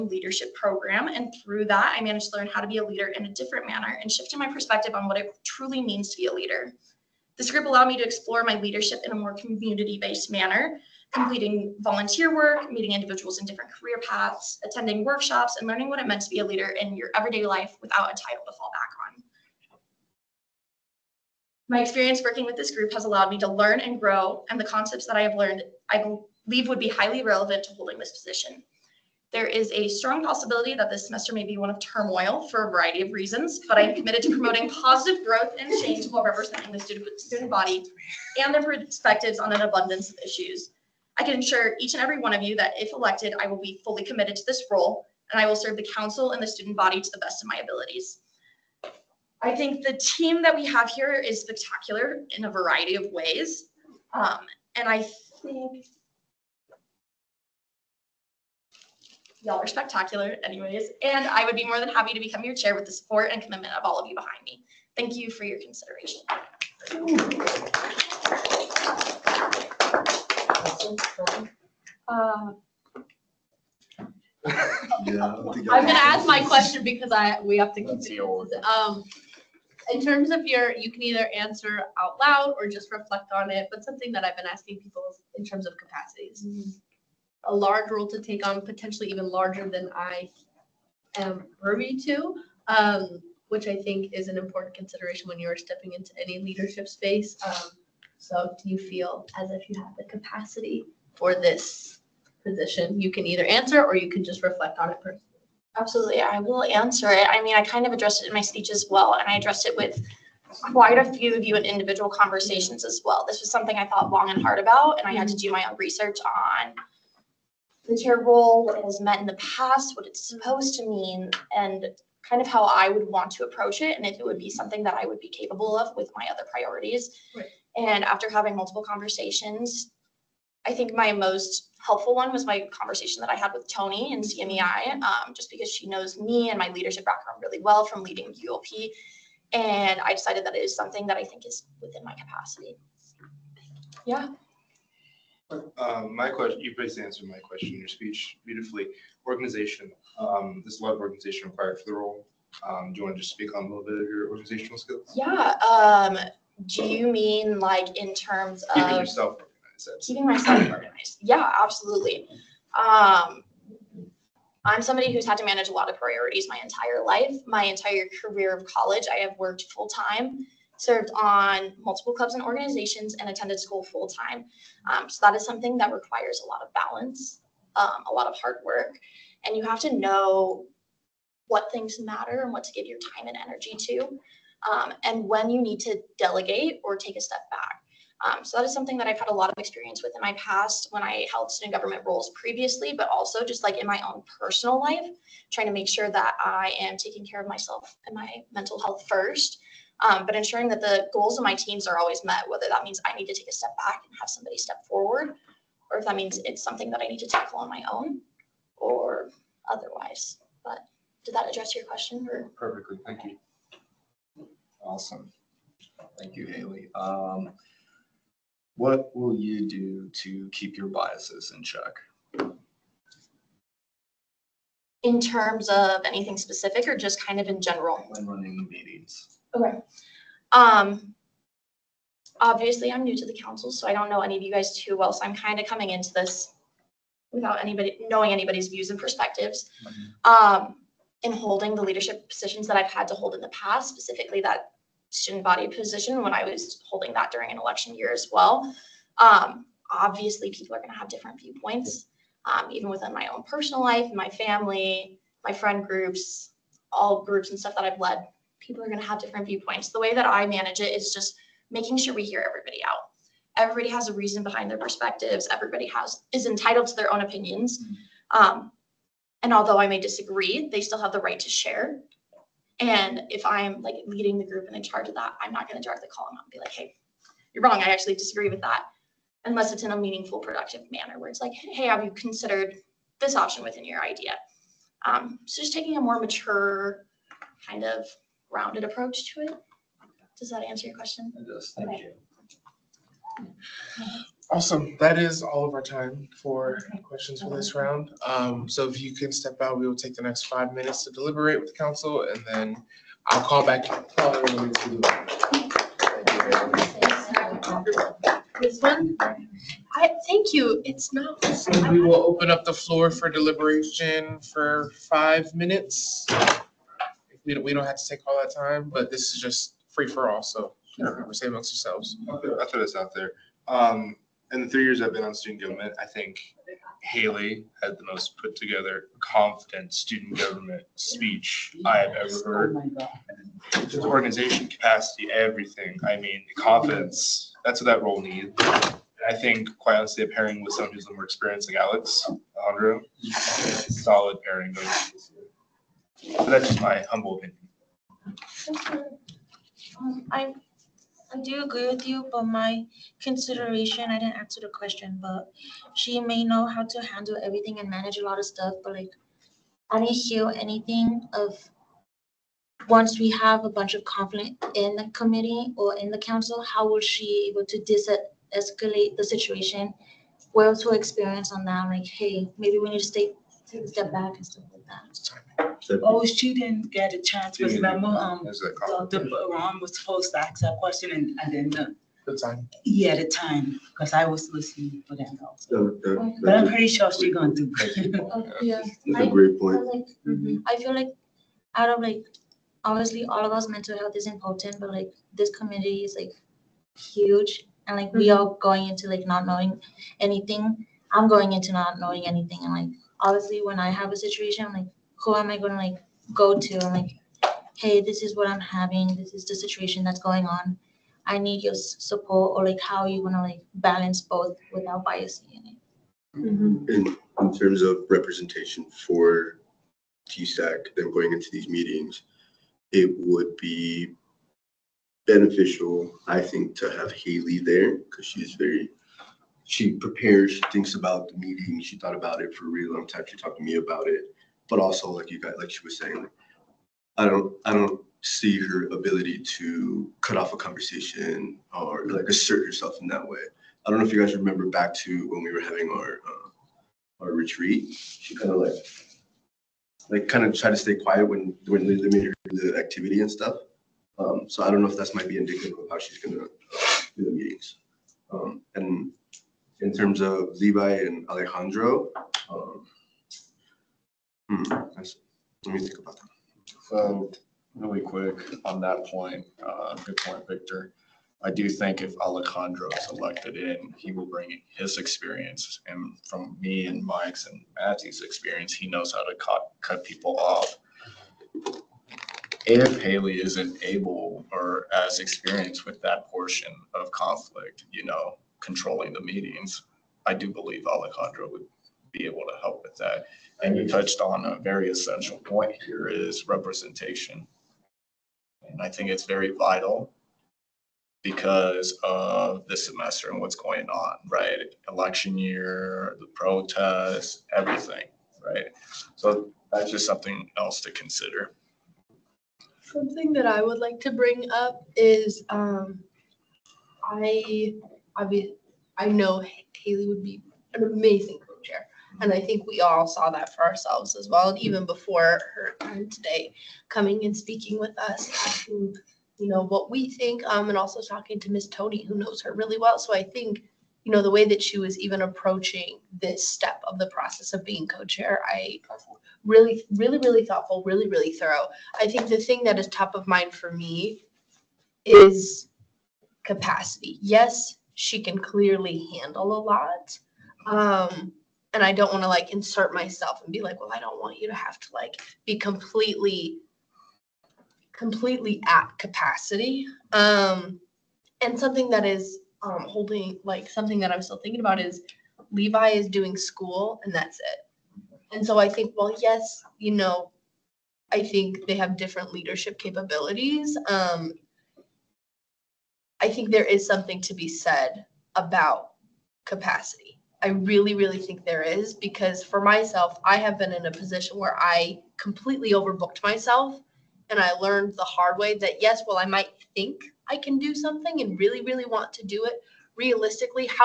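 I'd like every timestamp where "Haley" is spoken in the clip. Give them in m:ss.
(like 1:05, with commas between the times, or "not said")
3:36, 5:27, 7:07, 8:03, 8:39.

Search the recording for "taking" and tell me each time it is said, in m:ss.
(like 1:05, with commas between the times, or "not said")
3:16, 4:45.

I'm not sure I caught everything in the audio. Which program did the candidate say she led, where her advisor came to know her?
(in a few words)
ULP.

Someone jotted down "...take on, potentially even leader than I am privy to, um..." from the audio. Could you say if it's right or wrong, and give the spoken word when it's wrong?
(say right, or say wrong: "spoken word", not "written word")
wrong: "larger", not "leader".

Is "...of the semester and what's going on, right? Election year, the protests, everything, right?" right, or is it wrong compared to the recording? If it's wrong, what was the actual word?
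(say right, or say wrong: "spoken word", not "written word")
right.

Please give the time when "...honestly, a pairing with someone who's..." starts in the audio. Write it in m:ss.
5:39.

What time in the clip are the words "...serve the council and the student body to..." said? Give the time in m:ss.
0:45.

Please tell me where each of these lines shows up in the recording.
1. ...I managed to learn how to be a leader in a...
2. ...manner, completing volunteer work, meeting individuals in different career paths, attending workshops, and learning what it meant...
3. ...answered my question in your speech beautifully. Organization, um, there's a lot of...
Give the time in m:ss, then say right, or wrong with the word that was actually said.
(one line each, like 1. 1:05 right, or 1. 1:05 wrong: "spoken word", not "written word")
1. 0:01 right
2. 0:10 right
3. 2:27 right.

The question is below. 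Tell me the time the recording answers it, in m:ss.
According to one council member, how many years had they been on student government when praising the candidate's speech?
5:24.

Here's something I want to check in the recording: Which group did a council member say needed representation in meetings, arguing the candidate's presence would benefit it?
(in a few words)
TSAC.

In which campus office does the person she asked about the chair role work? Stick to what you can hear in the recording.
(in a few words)
CMEI.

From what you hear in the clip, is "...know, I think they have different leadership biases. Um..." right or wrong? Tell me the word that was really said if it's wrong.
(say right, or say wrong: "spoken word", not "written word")
wrong: "capabilities", not "biases".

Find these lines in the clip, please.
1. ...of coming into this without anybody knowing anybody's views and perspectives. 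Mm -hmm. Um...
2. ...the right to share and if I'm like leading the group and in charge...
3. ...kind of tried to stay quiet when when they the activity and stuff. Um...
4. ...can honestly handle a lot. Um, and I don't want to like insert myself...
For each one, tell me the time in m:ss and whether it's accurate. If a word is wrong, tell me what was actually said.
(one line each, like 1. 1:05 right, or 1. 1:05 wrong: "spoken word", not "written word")
1. 3:55 right
2. 4:31 right
3. 7:30 right
4. 9:08 wrong: "clearly", not "honestly".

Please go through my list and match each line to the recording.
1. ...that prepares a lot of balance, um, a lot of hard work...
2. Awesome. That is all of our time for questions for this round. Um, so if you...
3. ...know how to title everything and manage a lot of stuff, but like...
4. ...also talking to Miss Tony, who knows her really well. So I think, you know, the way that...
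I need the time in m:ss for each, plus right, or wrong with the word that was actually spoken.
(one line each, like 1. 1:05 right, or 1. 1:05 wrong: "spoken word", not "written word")
1. 2:55 wrong: "requires", not "prepares"
2. 4:54 right
3. 5:56 wrong: "handle", not "title"
4. 8:50 right.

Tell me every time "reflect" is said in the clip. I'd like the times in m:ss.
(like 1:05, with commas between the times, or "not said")
1:22, 1:44.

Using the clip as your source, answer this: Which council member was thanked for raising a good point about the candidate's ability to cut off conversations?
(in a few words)
Victor.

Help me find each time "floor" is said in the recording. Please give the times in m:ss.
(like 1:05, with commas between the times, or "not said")
5:12.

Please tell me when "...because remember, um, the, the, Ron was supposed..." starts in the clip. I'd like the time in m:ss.
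6:17.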